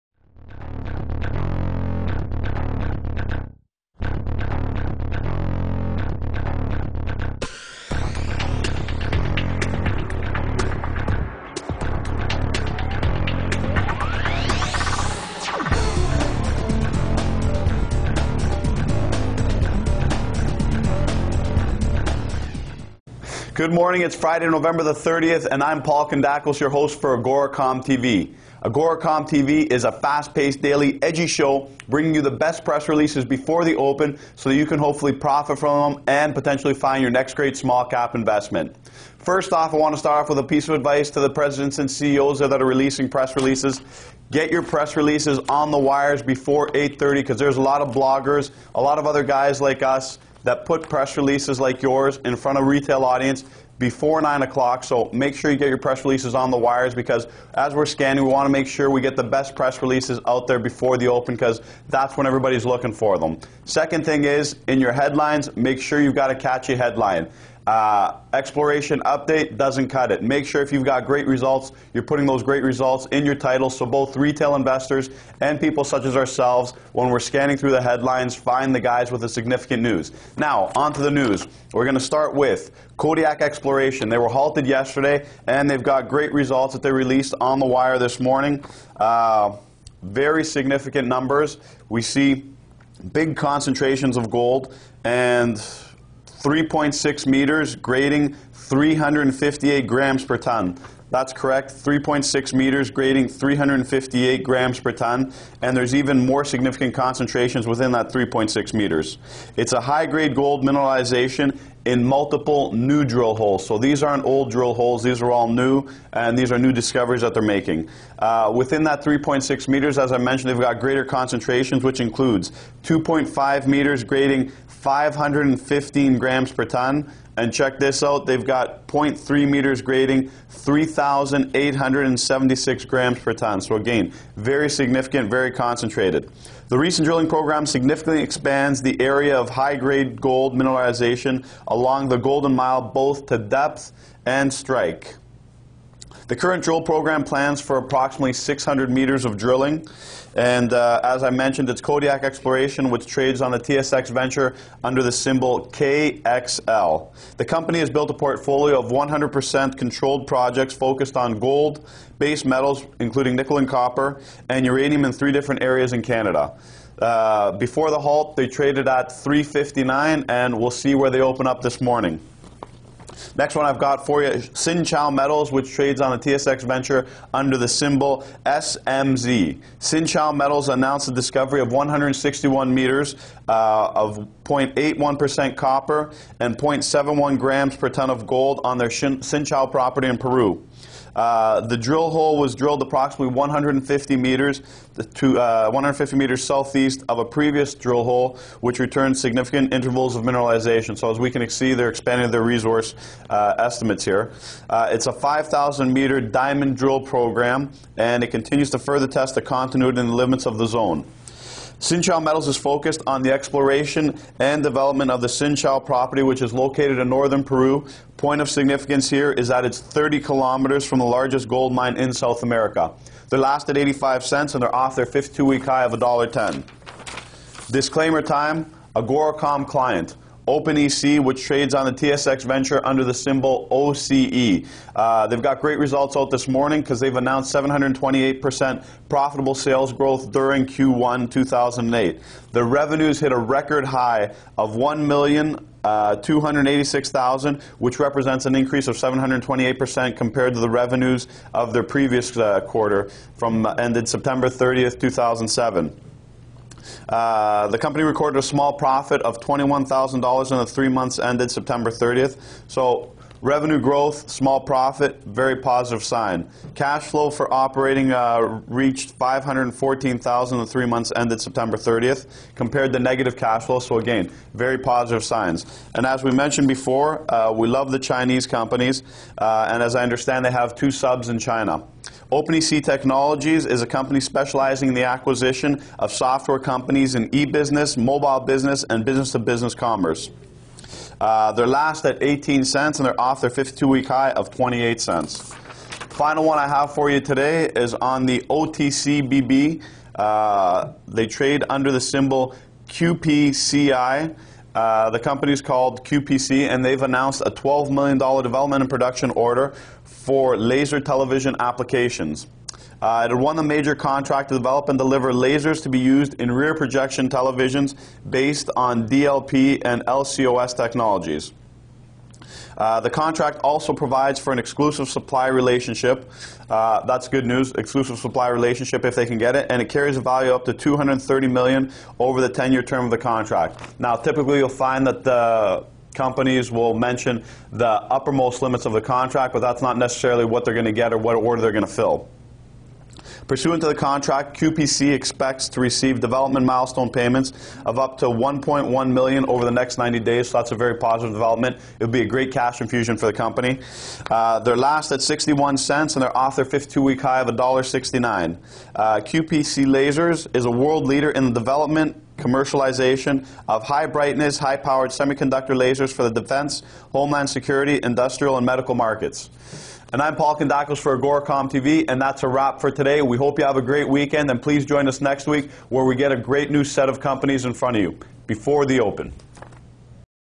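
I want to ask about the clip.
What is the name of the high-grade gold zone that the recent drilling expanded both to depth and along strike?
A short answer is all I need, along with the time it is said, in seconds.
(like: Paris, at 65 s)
Golden Mile, at 142 s.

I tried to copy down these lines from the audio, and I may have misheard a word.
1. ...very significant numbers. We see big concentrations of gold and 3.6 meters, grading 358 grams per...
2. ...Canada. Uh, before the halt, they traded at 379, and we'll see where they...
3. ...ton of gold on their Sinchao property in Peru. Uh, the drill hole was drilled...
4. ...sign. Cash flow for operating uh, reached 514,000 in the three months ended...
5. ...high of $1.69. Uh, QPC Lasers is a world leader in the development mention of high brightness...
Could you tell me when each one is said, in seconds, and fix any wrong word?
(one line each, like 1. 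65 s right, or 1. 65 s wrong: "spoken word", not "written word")
1. 90 s right
2. 166 s wrong: "359", not "379"
3. 187 s right
4. 266 s right
5. 357 s wrong: "commercialization", not "mention".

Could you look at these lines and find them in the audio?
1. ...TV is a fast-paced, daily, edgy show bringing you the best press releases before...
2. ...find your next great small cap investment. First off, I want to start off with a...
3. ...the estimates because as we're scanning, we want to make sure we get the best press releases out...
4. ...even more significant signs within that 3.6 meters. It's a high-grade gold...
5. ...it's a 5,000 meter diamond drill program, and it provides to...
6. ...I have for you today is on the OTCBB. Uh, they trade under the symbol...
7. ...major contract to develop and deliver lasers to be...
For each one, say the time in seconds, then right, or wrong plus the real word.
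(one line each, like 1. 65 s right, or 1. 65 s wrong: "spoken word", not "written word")
1. 29 s right
2. 36 s right
3. 56 s wrong: "wires", not "estimates"
4. 105 s wrong: "concentrations", not "signs"
5. 204 s wrong: "continues", not "provides"
6. 296 s right
7. 313 s right.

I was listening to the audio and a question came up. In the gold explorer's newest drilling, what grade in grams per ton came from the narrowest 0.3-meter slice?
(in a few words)
3,876.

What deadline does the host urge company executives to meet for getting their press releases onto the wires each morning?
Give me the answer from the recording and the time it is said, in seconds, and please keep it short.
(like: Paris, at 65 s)
8:30, at 46 s.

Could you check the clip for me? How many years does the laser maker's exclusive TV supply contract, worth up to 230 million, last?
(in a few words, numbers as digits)
10.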